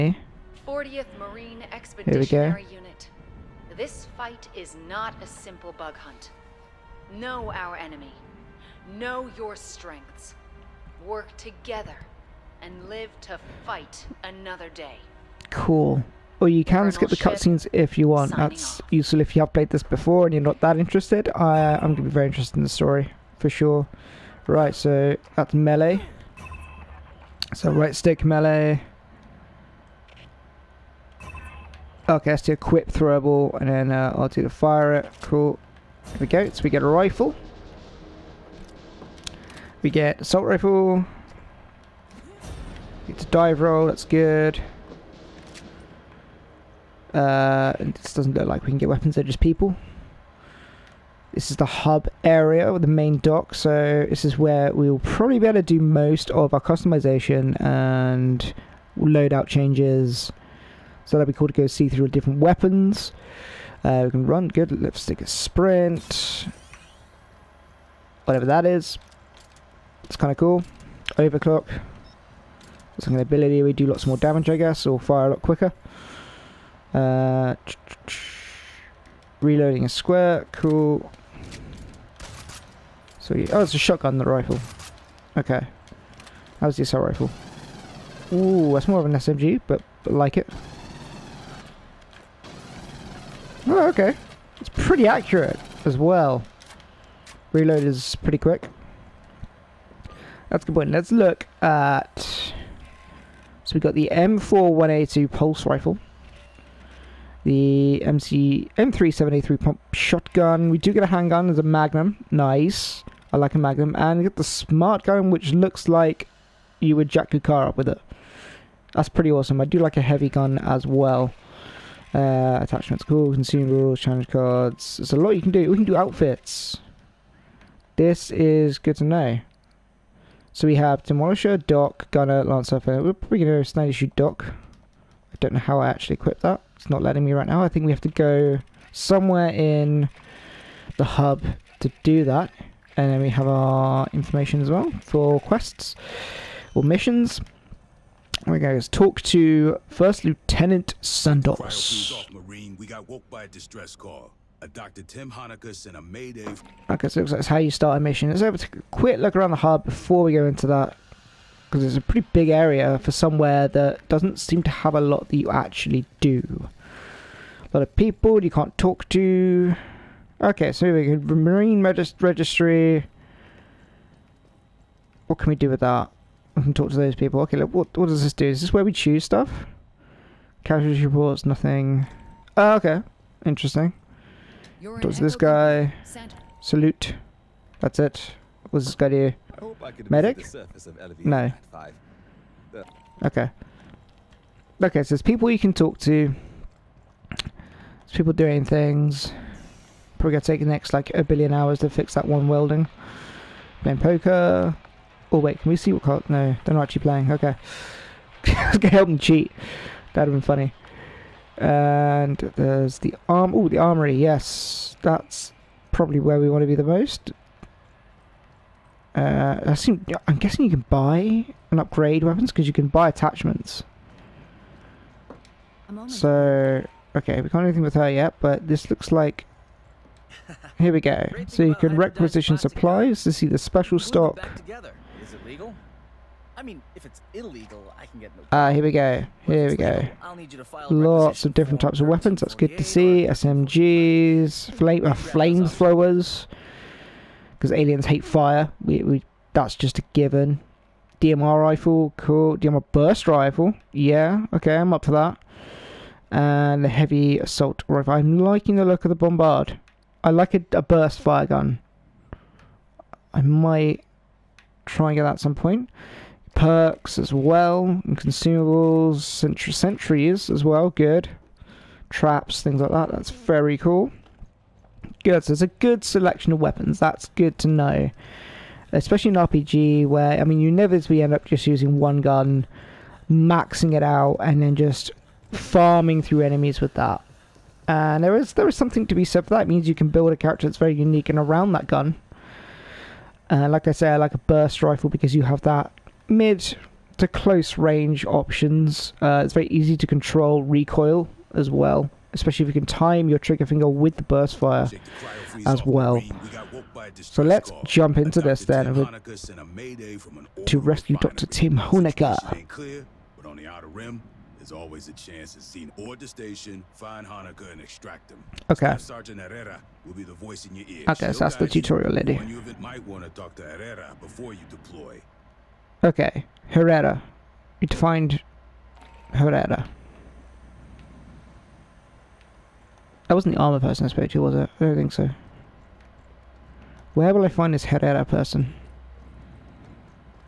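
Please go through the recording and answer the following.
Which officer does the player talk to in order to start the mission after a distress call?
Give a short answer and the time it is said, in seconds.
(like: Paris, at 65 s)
First Lieutenant Sandoz, at 149 s.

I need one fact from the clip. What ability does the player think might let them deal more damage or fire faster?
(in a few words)
Overclock.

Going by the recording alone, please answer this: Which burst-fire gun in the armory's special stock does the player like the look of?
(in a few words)
Bombard.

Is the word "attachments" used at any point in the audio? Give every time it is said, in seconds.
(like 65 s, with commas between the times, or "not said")
122 s, 223 s.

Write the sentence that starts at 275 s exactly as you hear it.
Good, so it's a good selection of weapons, that's good to know.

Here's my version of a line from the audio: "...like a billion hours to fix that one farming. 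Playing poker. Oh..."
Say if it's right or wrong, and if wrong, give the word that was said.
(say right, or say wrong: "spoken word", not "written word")
wrong: "welding", not "farming".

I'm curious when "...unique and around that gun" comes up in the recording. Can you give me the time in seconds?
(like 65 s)
290 s.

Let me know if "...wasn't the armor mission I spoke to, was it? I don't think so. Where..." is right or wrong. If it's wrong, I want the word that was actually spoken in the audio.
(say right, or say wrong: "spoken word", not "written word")
wrong: "person", not "mission".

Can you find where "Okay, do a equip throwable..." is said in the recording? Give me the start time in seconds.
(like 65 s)
32 s.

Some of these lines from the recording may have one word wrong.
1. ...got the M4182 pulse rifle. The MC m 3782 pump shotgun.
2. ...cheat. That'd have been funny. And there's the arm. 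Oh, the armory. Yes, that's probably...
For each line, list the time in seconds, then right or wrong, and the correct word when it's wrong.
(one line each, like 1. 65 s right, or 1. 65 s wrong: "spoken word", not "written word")
1. 103 s wrong: "3783", not "3782"
2. 209 s right.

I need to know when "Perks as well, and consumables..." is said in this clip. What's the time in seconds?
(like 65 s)
266 s.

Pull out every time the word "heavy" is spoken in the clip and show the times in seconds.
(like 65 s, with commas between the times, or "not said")
120 s, 256 s.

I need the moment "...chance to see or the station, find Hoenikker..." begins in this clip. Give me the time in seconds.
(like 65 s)
315 s.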